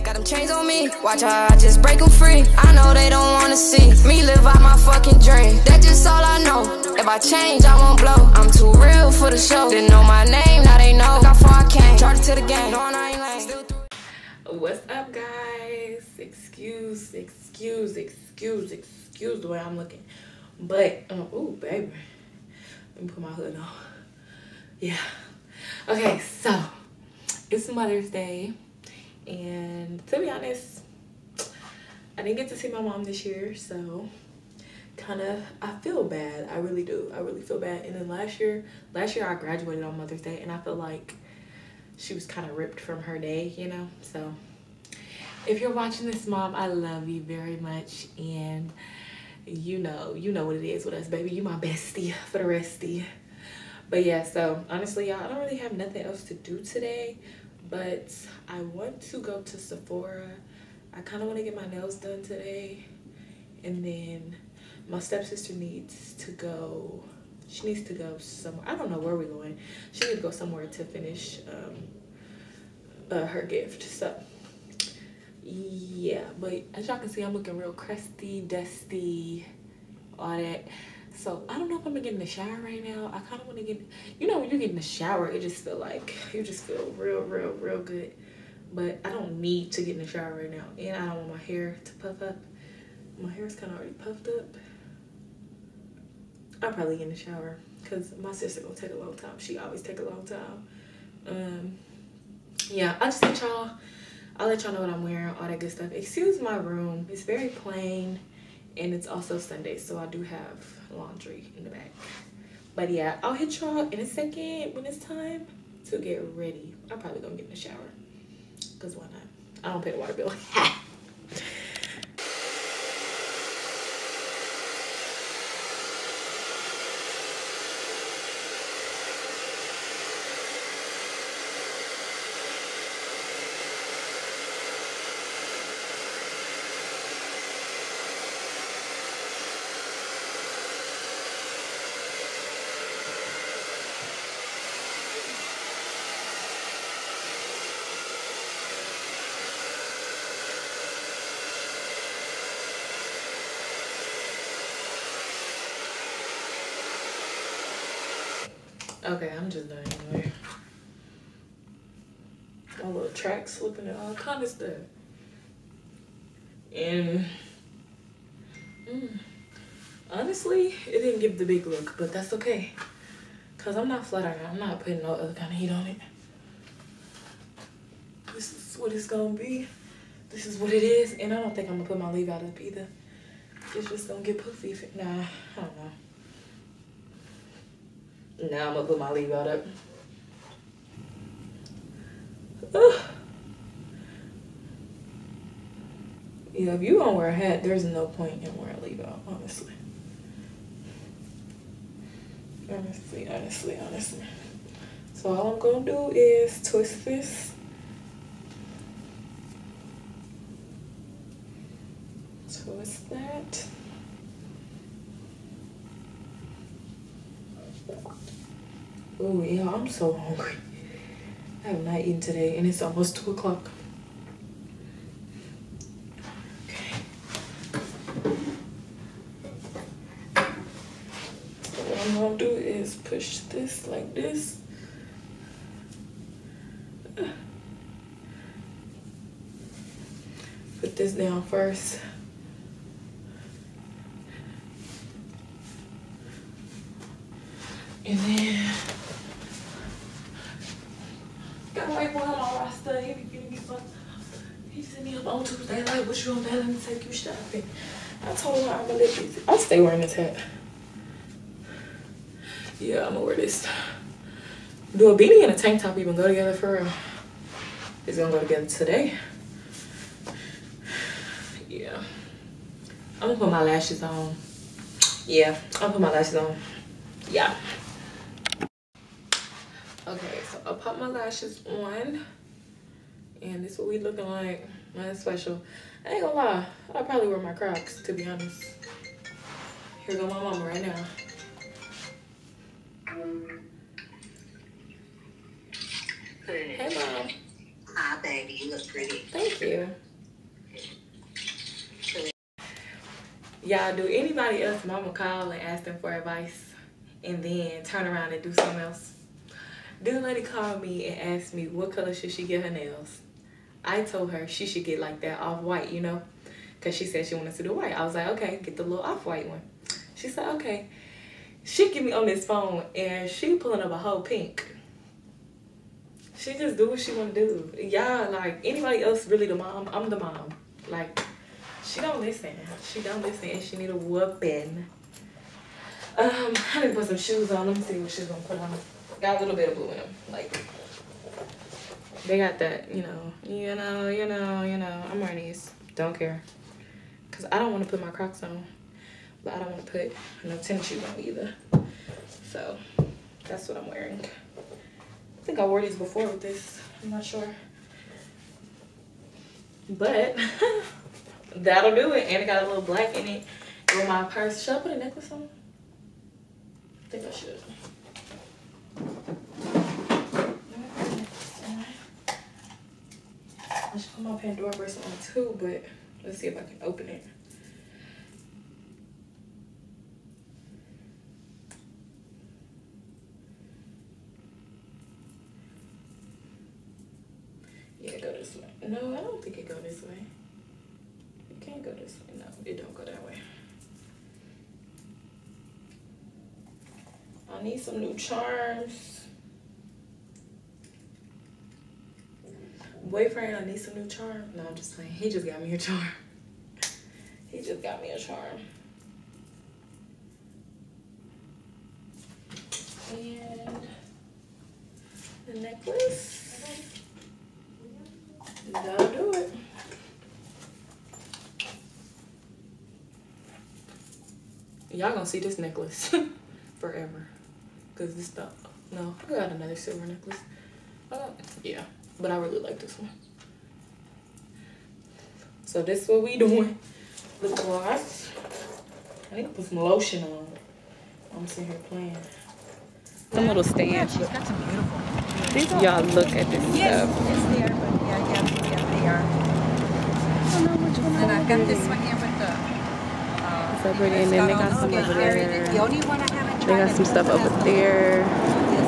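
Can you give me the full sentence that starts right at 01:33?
My hair is kind of already puffed up.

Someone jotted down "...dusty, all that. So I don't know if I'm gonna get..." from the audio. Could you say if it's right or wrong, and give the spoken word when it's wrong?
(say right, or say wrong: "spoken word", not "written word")
right.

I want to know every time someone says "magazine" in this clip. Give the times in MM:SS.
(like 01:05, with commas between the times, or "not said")
not said.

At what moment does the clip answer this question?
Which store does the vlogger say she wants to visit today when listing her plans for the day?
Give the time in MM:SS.
00:59.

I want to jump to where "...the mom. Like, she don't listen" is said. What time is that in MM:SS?
05:30.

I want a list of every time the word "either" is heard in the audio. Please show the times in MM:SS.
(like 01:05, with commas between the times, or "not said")
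03:02, 05:51.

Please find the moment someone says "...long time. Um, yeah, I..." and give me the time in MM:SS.
01:40.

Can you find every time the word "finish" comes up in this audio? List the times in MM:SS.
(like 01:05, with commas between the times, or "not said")
01:10.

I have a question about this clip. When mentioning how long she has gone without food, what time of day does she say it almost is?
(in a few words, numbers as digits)
2 o'clock.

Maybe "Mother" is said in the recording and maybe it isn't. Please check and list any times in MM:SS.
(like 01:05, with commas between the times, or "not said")
00:27, 00:39.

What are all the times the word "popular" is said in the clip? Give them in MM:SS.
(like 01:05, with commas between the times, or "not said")
not said.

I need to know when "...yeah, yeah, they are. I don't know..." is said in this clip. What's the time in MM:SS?
07:28.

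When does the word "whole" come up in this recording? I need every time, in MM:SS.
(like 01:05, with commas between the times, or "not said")
05:23.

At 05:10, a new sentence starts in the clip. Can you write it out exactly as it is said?
This lady called me and asked me what color should she get her nails.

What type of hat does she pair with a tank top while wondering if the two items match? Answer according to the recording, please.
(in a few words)
A beanie.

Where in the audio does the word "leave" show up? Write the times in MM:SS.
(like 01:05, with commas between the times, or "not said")
03:02, 03:09, 03:18.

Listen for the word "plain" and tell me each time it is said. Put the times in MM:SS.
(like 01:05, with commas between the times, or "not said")
01:47.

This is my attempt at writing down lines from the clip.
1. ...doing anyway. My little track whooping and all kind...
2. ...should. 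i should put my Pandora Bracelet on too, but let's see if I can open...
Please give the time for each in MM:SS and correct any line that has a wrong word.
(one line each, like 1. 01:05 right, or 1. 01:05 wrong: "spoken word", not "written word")
1. 02:39 wrong: "slipping", not "whooping"
2. 06:07 right.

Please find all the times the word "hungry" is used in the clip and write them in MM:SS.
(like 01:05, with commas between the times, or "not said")
03:40.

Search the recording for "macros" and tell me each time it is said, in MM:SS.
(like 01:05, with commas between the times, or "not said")
not said.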